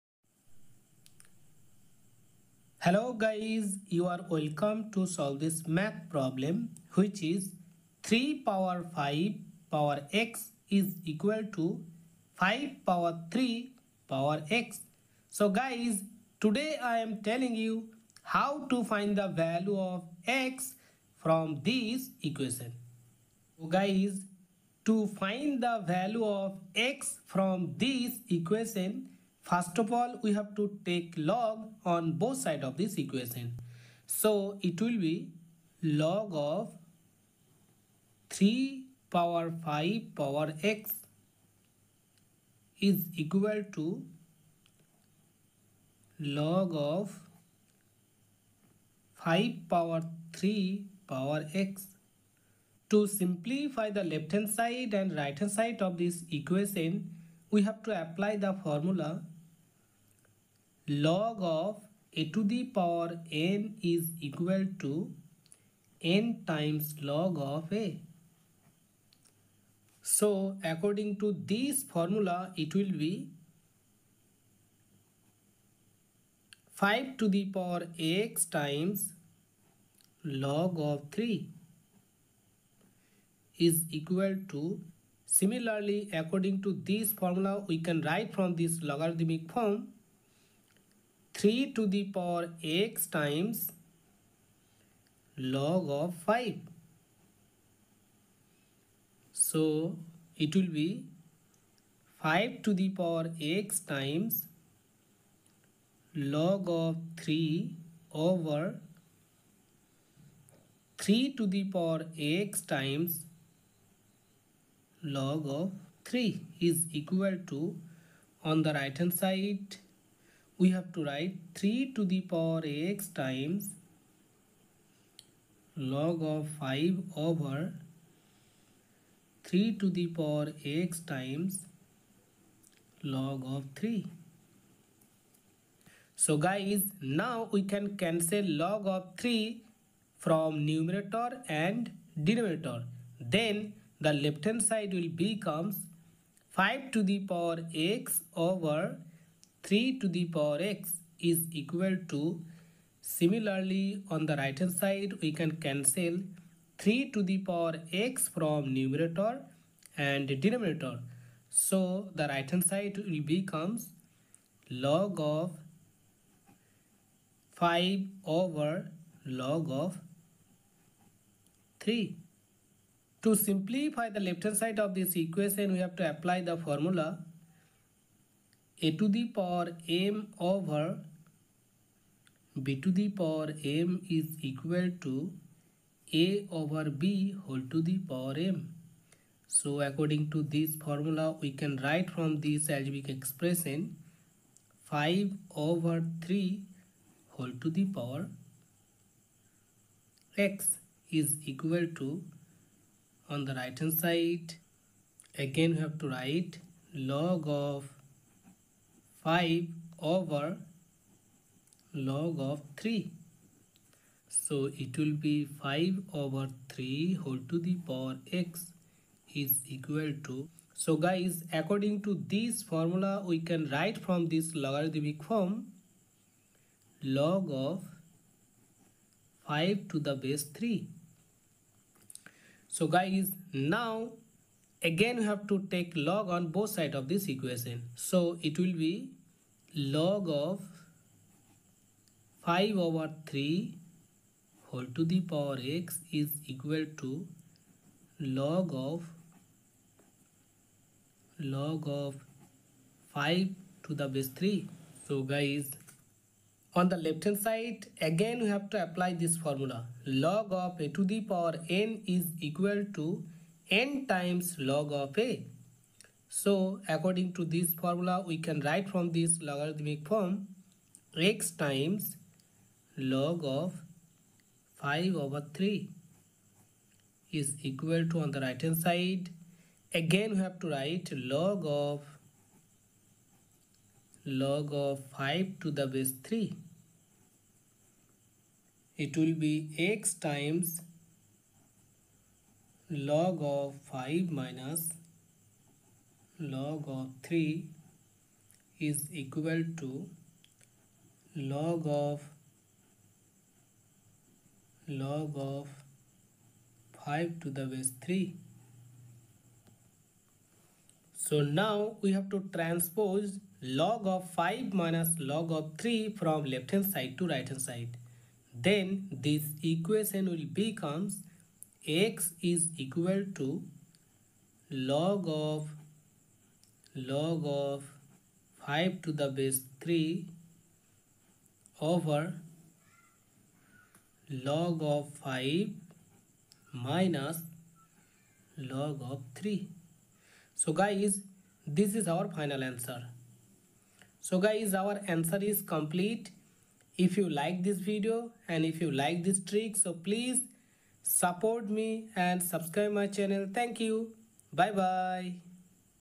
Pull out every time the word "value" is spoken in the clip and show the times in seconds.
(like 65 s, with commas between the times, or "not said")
19 s, 25 s.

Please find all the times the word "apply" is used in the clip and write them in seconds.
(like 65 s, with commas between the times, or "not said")
58 s, 176 s, 258 s.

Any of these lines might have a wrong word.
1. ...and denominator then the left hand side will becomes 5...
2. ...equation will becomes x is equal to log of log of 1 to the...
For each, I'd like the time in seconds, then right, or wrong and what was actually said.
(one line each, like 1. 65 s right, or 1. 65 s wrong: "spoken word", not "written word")
1. 141 s right
2. 319 s wrong: "5", not "1".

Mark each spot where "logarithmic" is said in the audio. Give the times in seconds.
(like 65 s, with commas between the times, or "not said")
88 s, 224 s, 269 s.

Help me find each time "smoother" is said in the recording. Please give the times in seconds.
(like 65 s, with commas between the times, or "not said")
not said.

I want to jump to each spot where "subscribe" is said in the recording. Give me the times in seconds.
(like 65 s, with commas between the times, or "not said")
352 s.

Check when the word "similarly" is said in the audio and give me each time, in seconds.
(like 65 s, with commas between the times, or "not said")
85 s, 153 s.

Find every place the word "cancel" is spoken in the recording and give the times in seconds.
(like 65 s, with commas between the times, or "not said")
137 s, 155 s.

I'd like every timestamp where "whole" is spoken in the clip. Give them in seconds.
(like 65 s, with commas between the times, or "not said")
187 s, 197 s, 217 s, 244 s.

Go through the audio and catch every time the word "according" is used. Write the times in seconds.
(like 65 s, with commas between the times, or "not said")
70 s, 86 s, 189 s, 221 s, 266 s.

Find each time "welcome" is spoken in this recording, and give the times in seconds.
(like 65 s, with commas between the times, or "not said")
4 s.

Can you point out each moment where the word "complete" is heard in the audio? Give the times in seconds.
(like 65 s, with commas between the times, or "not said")
345 s.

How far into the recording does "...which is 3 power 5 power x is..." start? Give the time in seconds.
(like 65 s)
6 s.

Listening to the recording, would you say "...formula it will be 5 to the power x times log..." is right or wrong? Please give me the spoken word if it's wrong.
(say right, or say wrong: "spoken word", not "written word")
right.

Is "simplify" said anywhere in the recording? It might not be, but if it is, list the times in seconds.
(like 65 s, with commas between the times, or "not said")
53 s, 173 s.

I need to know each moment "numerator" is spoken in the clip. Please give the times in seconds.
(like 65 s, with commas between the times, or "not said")
140 s, 158 s.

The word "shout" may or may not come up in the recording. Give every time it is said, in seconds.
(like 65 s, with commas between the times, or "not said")
not said.